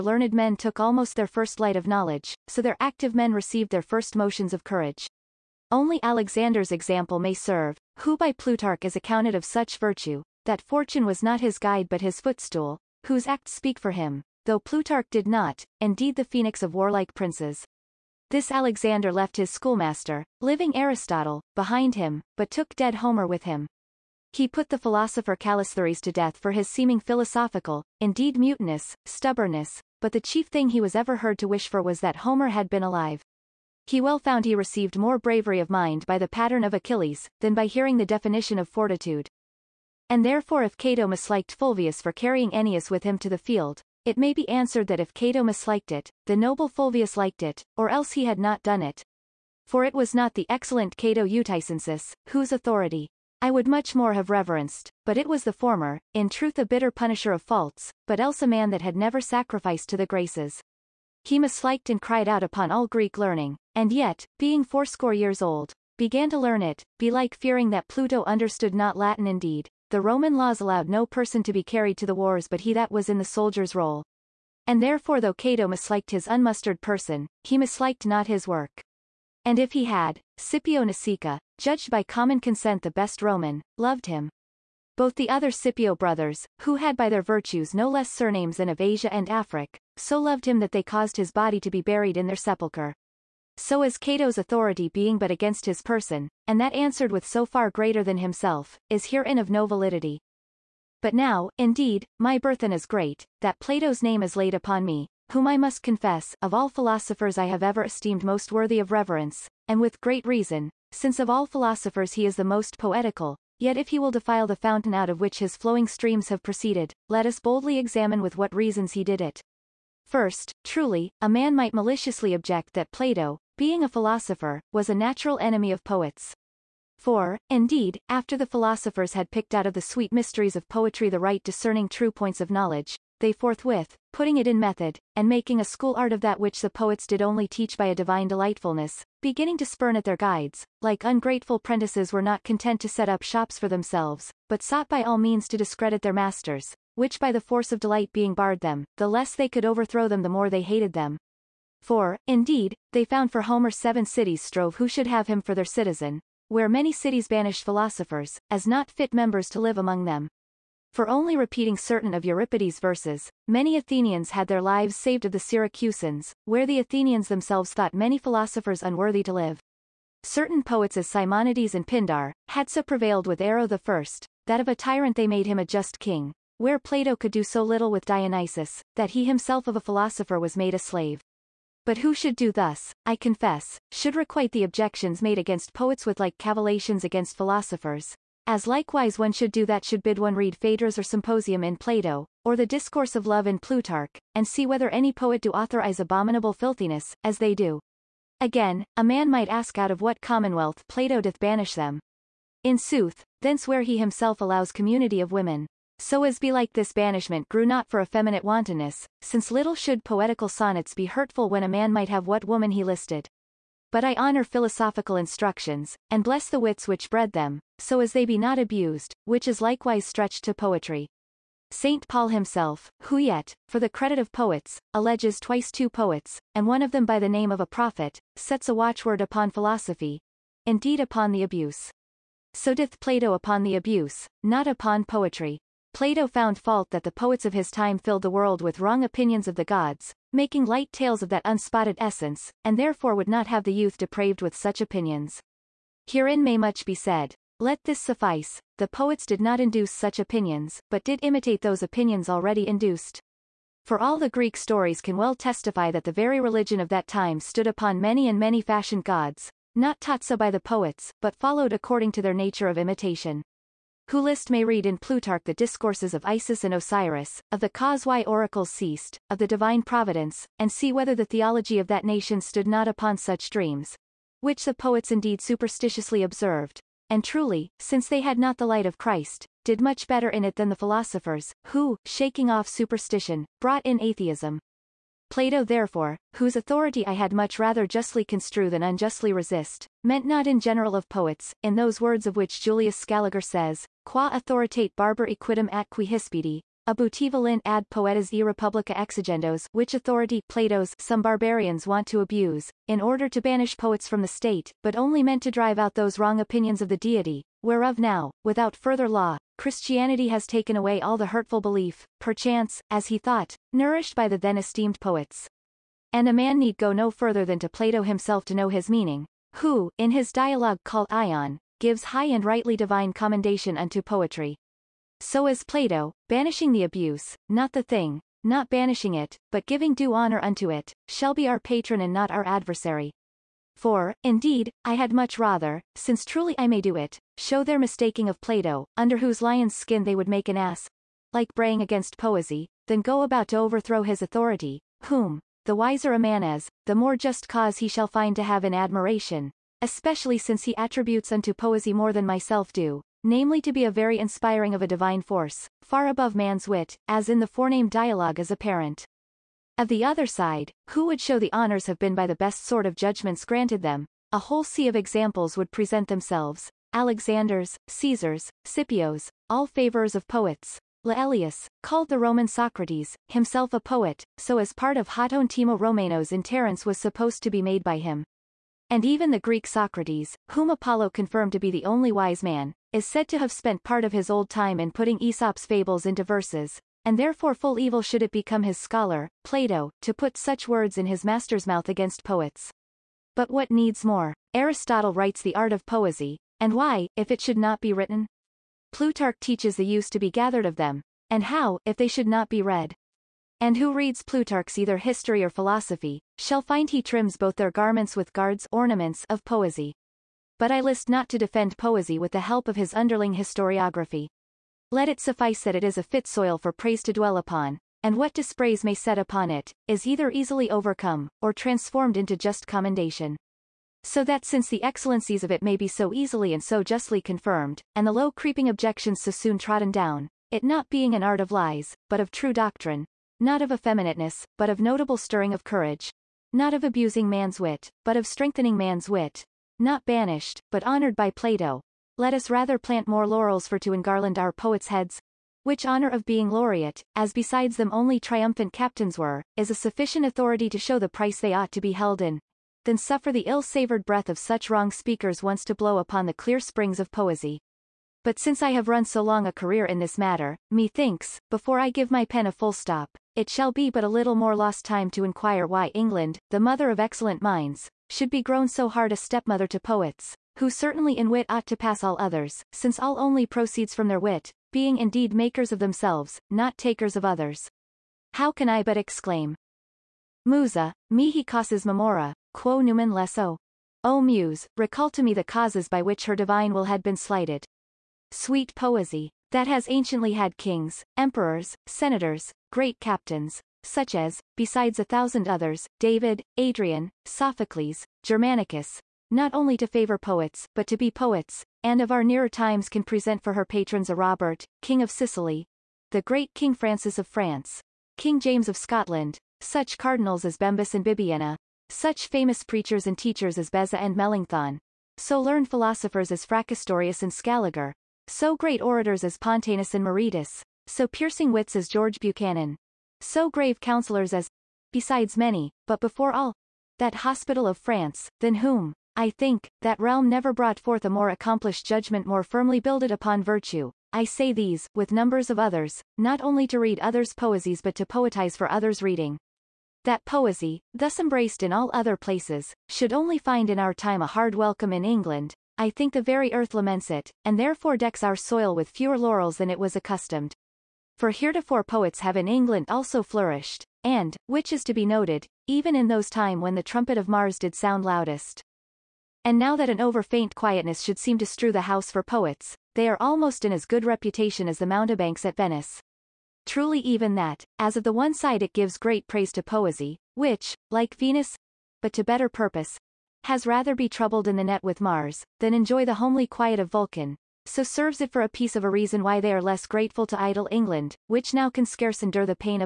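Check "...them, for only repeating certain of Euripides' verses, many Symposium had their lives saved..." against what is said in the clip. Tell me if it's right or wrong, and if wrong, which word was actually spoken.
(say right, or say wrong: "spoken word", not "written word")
wrong: "Athenians", not "Symposium".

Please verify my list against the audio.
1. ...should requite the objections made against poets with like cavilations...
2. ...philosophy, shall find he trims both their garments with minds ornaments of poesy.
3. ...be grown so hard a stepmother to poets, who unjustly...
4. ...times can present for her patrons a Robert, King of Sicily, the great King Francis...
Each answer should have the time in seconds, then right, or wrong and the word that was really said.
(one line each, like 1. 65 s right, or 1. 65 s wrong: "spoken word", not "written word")
1. 183 s right
2. 405 s wrong: "guards", not "minds"
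3. 468 s wrong: "certainly", not "unjustly"
4. 502 s right.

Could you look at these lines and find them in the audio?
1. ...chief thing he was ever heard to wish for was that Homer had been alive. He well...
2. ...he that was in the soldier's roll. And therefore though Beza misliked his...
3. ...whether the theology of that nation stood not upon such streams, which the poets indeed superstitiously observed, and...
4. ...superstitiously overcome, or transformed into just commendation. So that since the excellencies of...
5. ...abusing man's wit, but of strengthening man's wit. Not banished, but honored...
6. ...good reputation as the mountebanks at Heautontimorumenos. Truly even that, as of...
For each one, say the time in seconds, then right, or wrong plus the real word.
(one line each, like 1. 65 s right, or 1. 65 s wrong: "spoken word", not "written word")
1. 30 s right
2. 72 s wrong: "Cato", not "Beza"
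3. 270 s wrong: "dreams", not "streams"
4. 420 s wrong: "easily", not "superstitiously"
5. 436 s right
6. 563 s wrong: "Venice", not "Heautontimorumenos".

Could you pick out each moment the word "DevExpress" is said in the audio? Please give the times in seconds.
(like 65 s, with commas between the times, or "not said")
not said.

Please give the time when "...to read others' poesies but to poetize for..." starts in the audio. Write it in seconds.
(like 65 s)
536 s.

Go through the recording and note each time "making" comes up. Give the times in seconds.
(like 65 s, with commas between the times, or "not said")
135 s, 240 s.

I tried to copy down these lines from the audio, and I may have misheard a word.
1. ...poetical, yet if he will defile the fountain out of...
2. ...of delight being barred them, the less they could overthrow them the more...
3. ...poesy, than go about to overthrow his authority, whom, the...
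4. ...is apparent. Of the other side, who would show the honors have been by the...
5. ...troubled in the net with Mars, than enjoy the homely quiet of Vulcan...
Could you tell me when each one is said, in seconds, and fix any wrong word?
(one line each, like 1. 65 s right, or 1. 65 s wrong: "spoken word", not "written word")
1. 112 s right
2. 147 s right
3. 342 s right
4. 358 s right
5. 574 s right.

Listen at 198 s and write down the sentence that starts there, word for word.
Again, a man might ask out of what commonwealth Plato doth banish them.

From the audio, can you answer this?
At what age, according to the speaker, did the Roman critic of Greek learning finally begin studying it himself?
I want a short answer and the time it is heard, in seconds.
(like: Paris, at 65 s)
80, at 64 s.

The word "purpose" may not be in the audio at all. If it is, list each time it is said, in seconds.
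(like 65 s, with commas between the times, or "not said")
572 s.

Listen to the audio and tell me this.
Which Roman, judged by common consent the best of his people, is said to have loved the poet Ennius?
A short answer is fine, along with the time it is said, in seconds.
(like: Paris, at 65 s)
Scipio Nasica, at 80 s.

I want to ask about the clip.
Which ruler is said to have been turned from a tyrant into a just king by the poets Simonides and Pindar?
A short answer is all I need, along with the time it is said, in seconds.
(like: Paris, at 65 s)
Hiero the First, at 173 s.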